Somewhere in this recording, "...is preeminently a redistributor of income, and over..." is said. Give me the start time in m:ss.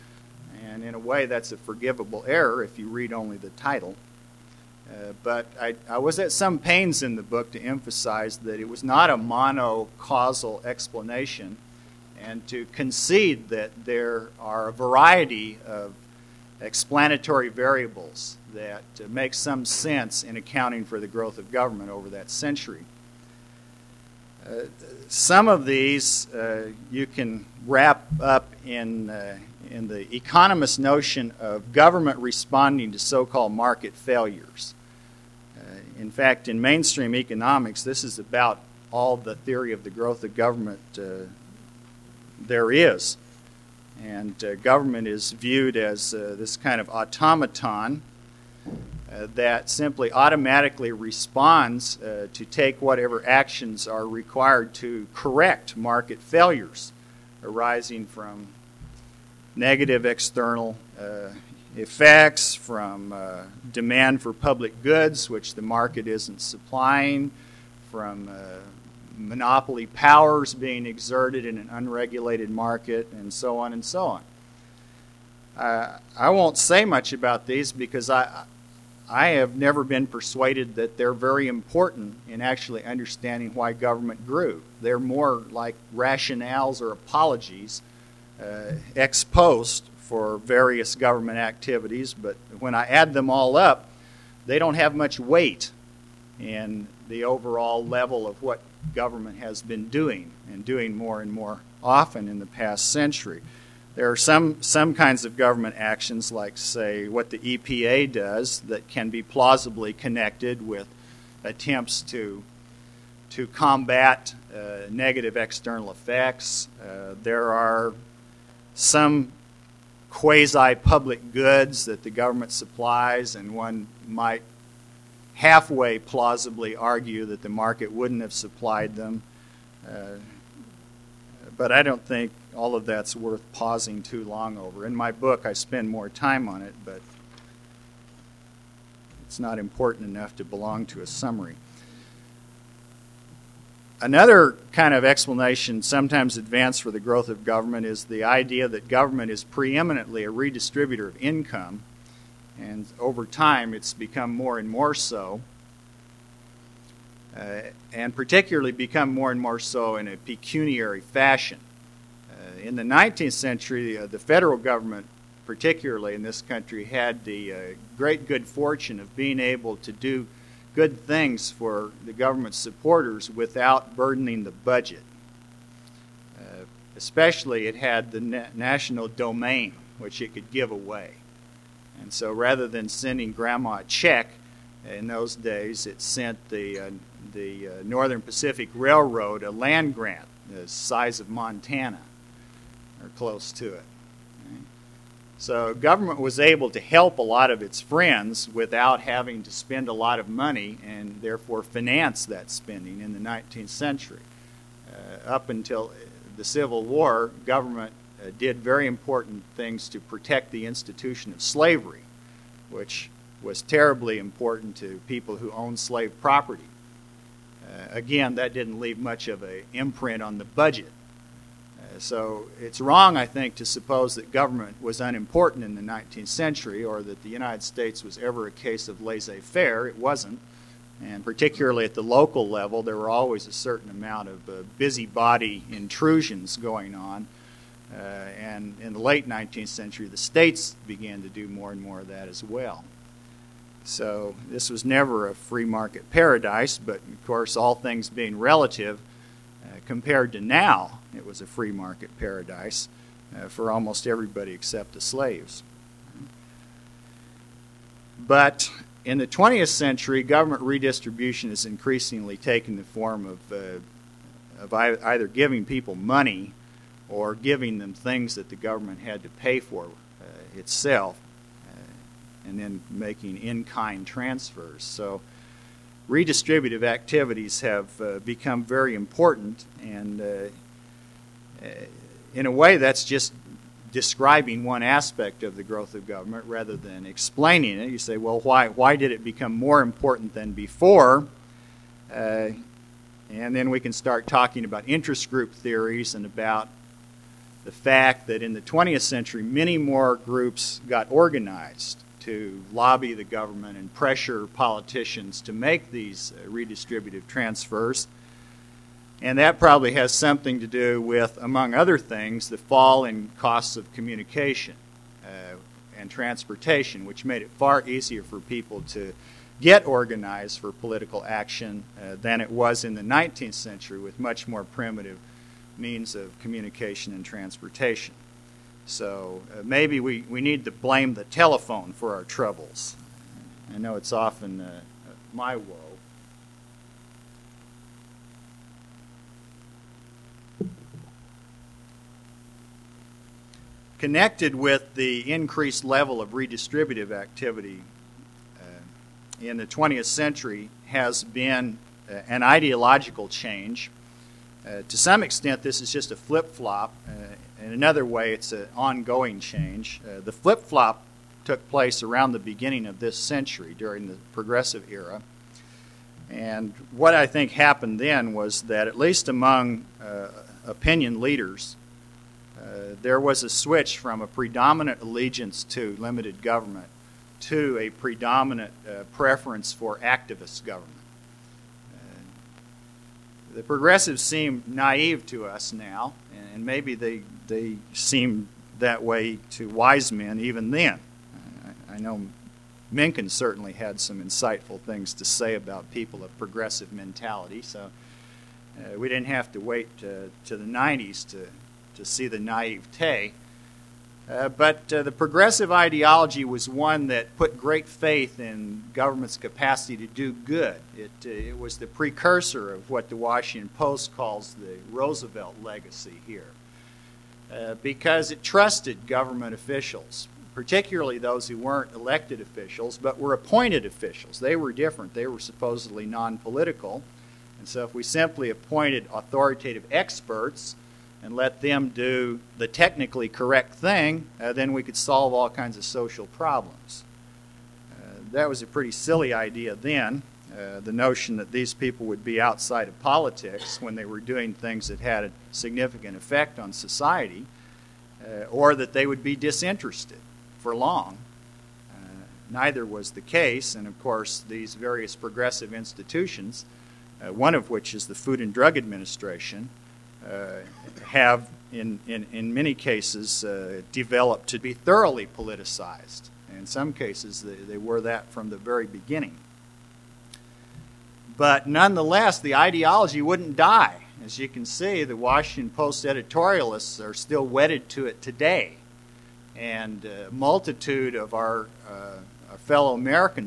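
2:29.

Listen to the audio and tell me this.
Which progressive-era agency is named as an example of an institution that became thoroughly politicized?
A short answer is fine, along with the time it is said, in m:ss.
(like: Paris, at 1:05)
Food and Drug Administration, at 7:38.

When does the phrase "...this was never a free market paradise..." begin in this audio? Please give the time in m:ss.
4:04.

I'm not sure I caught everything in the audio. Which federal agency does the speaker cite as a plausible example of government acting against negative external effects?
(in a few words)
EPA.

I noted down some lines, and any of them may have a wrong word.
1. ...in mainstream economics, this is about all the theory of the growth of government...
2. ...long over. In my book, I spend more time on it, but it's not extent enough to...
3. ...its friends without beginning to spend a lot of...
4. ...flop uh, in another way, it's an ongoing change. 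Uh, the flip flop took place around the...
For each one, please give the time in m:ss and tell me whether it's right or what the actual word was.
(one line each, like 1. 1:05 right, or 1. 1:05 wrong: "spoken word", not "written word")
1. 0:36 right
2. 2:14 wrong: "important", not "extent"
3. 3:17 wrong: "having", not "beginning"
4. 5:56 right.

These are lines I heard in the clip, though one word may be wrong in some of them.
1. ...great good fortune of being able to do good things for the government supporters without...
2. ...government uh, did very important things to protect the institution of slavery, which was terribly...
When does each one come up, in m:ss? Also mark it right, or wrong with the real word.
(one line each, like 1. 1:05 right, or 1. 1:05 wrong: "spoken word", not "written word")
1. 2:47 right
2. 3:27 right.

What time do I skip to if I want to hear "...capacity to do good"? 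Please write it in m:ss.
6:49.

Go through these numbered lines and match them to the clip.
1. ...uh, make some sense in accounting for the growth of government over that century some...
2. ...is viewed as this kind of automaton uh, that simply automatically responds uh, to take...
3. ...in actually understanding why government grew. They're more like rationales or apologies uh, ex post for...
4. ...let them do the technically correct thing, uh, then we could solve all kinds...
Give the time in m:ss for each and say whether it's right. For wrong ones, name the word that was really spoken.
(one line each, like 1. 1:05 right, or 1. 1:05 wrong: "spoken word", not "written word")
1. 0:18 right
2. 0:45 right
3. 1:22 right
4. 7:11 right.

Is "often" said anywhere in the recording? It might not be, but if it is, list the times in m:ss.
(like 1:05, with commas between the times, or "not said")
1:41, 5:34.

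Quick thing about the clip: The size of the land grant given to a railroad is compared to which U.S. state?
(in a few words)
Montana.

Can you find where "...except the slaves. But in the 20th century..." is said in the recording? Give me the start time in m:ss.
4:14.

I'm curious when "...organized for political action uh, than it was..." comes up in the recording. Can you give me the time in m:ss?
5:19.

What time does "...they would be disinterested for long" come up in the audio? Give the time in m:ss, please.
7:28.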